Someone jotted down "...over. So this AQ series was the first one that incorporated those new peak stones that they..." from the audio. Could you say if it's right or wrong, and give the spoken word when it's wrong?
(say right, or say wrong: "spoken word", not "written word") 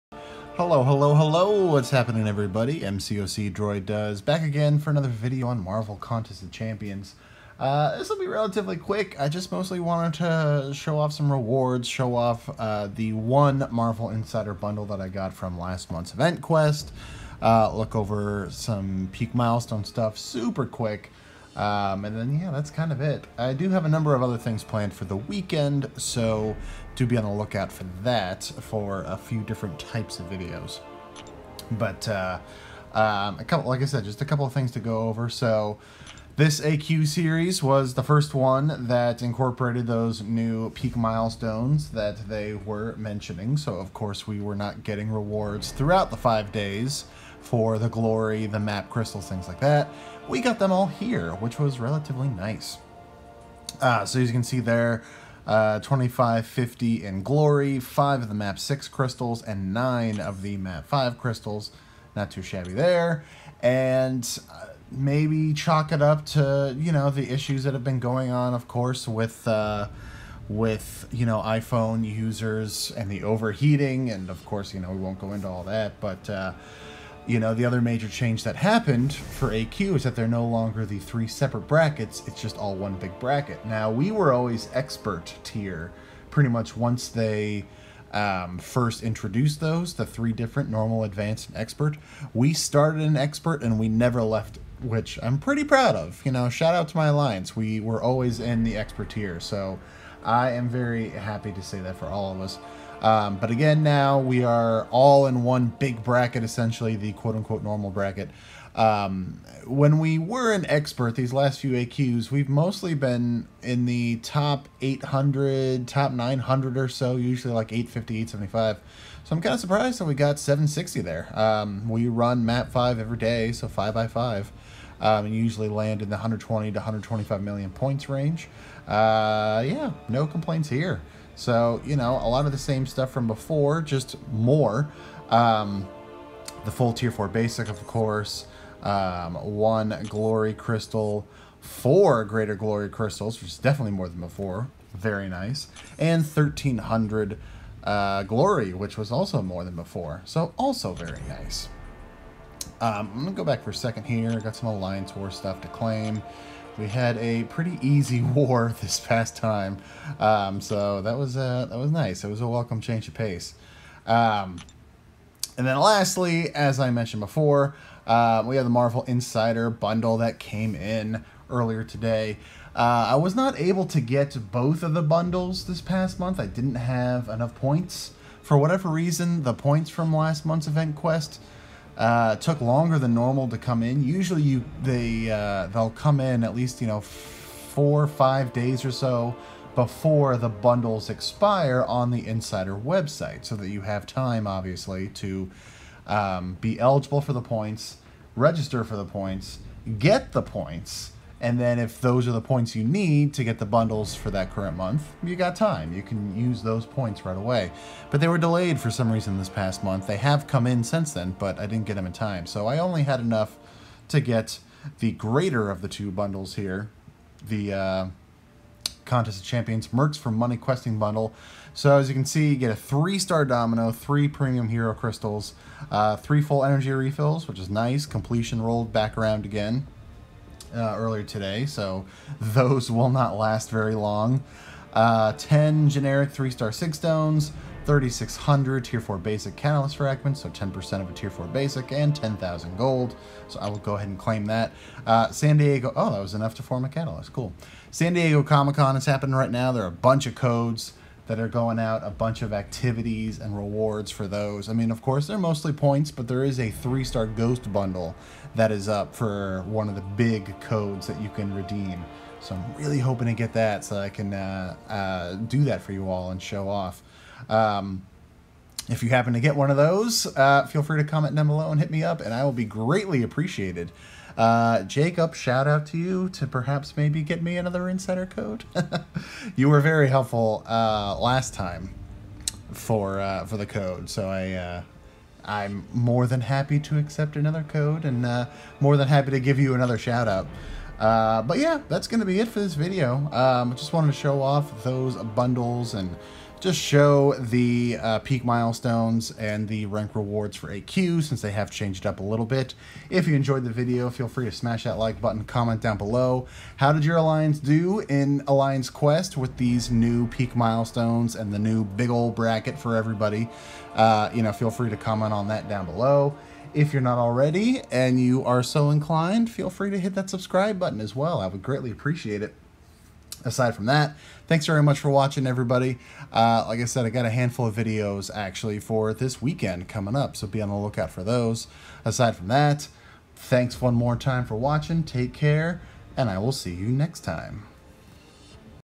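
wrong: "milestones", not "stones".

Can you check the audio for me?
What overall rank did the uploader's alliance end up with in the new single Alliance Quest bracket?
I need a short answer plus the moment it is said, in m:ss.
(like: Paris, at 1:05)
760, at 2:00.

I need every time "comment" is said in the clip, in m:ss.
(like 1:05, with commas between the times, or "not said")
4:31, 5:05, 5:14.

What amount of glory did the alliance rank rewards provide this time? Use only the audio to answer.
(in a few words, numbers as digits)
1300.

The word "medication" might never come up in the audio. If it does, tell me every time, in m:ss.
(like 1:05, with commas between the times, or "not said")
not said.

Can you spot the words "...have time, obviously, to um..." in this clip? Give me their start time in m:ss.
3:13.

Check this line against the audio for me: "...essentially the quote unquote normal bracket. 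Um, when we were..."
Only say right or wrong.
right.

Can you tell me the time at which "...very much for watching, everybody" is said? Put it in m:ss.
5:24.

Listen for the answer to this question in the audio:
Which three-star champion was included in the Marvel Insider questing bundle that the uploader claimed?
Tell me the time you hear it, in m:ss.
3:42.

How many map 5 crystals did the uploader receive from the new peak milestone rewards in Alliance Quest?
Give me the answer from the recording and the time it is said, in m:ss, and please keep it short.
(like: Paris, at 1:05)
9, at 0:59.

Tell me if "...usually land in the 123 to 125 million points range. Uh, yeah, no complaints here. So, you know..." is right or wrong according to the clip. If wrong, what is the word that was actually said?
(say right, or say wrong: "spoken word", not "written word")
wrong: "120", not "123".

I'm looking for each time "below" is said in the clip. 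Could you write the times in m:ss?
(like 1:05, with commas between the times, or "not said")
4:31, 5:05, 5:15.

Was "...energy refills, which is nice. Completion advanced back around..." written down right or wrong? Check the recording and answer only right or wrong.
wrong.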